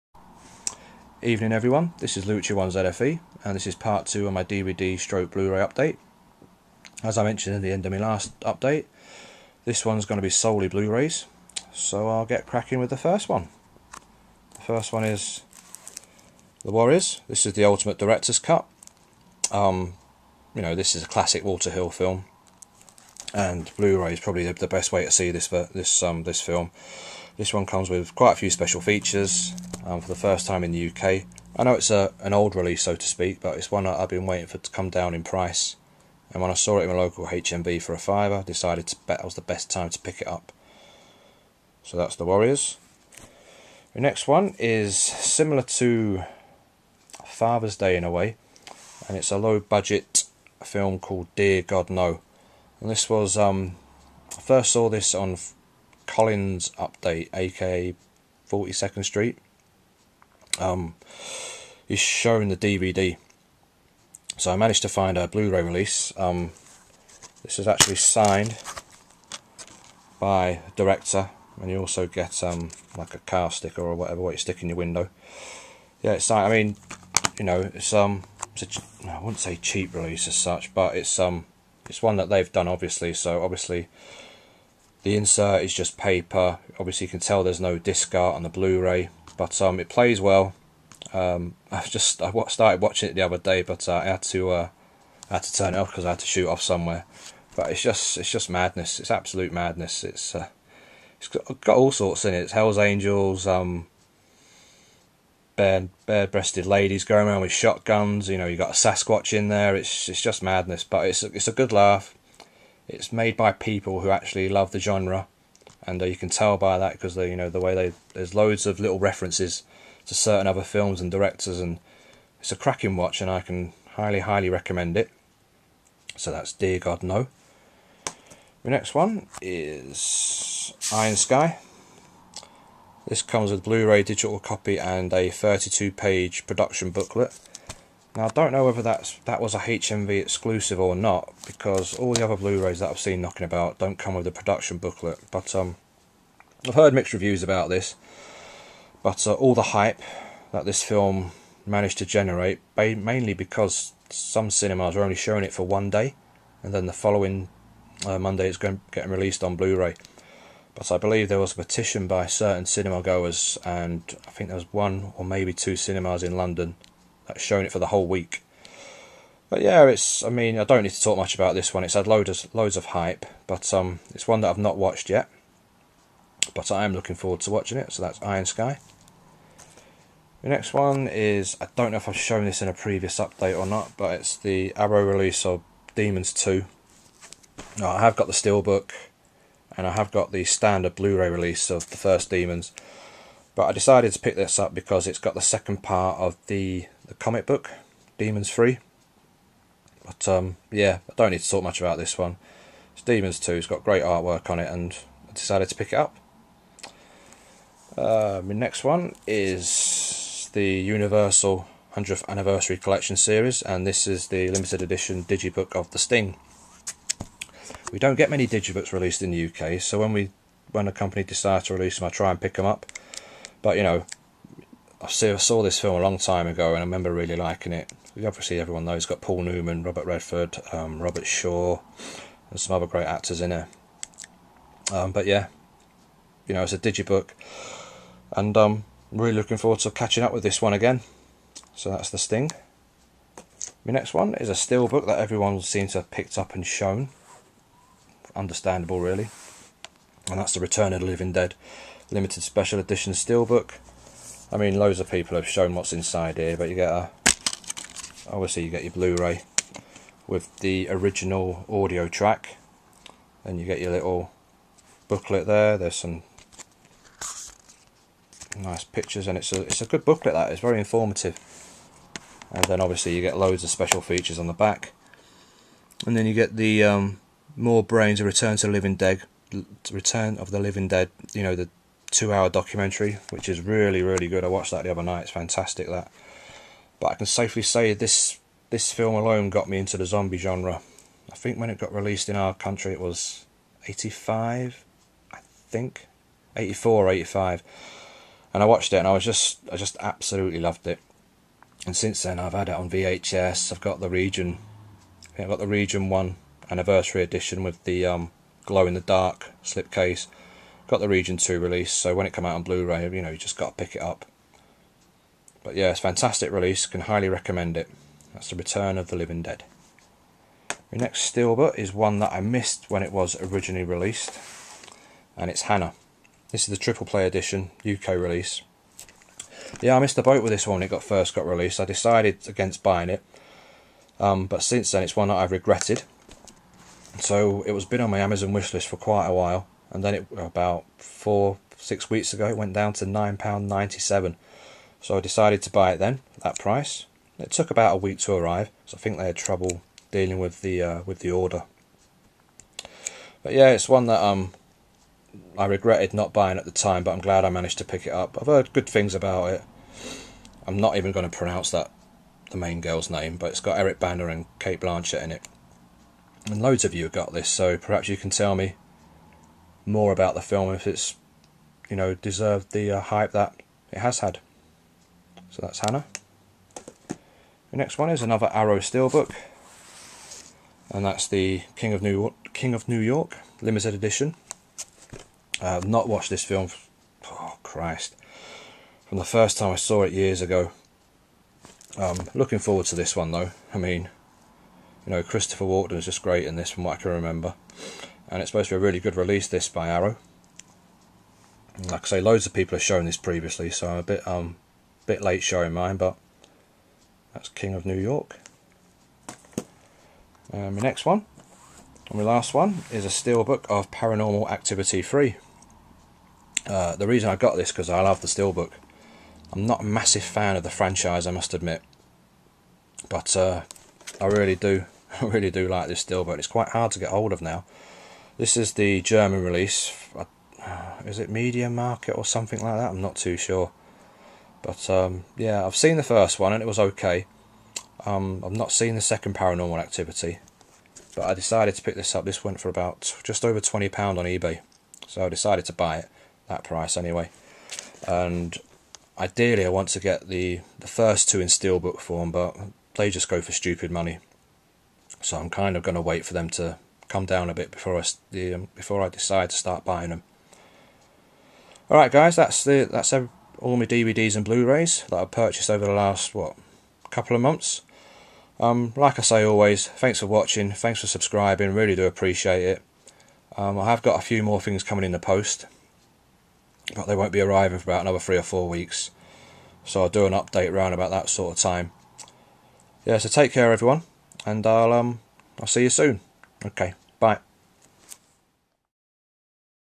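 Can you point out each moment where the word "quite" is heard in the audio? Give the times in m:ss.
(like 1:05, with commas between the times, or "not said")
0:28, 5:38, 7:06.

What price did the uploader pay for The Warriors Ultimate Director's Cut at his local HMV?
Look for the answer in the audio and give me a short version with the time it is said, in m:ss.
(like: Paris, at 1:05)
a fiver, at 0:37.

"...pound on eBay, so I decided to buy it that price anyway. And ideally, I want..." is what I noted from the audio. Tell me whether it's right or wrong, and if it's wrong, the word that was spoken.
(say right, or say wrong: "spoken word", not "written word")
right.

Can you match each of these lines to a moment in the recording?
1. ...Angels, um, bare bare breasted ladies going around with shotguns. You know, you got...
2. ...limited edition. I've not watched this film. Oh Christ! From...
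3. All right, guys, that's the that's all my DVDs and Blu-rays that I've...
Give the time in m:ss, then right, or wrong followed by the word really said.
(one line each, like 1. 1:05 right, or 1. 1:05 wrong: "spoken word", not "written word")
1. 1:42 right
2. 6:23 right
3. 7:41 right.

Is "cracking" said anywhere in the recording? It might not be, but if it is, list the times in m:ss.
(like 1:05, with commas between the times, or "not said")
0:12, 2:02.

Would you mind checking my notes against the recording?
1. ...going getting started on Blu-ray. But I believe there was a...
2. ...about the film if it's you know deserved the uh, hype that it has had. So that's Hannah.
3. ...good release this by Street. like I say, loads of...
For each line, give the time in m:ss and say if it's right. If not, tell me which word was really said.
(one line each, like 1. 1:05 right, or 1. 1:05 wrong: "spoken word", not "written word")
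1. 2:38 wrong: "released", not "started"
2. 6:10 right
3. 6:38 wrong: "Arrow", not "Street".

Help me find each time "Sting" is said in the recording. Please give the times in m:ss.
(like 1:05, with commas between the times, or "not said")
3:35, 4:02.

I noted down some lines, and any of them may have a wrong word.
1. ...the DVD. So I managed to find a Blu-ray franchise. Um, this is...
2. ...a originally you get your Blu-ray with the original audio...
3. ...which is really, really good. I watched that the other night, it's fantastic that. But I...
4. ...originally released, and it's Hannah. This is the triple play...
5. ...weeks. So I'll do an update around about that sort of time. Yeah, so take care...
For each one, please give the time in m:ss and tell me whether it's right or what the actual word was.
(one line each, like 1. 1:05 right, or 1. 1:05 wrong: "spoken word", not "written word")
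1. 1:02 wrong: "release", not "franchise"
2. 4:16 wrong: "obviously", not "originally"
3. 4:43 right
4. 5:23 right
5. 7:58 right.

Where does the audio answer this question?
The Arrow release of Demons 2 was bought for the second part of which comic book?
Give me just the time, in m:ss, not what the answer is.
3:18.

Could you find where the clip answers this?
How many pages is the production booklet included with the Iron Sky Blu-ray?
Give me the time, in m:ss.
2:15.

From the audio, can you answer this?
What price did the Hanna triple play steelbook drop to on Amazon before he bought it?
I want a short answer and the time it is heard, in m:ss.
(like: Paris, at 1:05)
£9.97, at 5:43.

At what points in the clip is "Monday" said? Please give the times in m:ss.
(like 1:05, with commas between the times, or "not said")
2:38.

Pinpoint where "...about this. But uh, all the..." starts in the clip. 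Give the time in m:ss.
2:27.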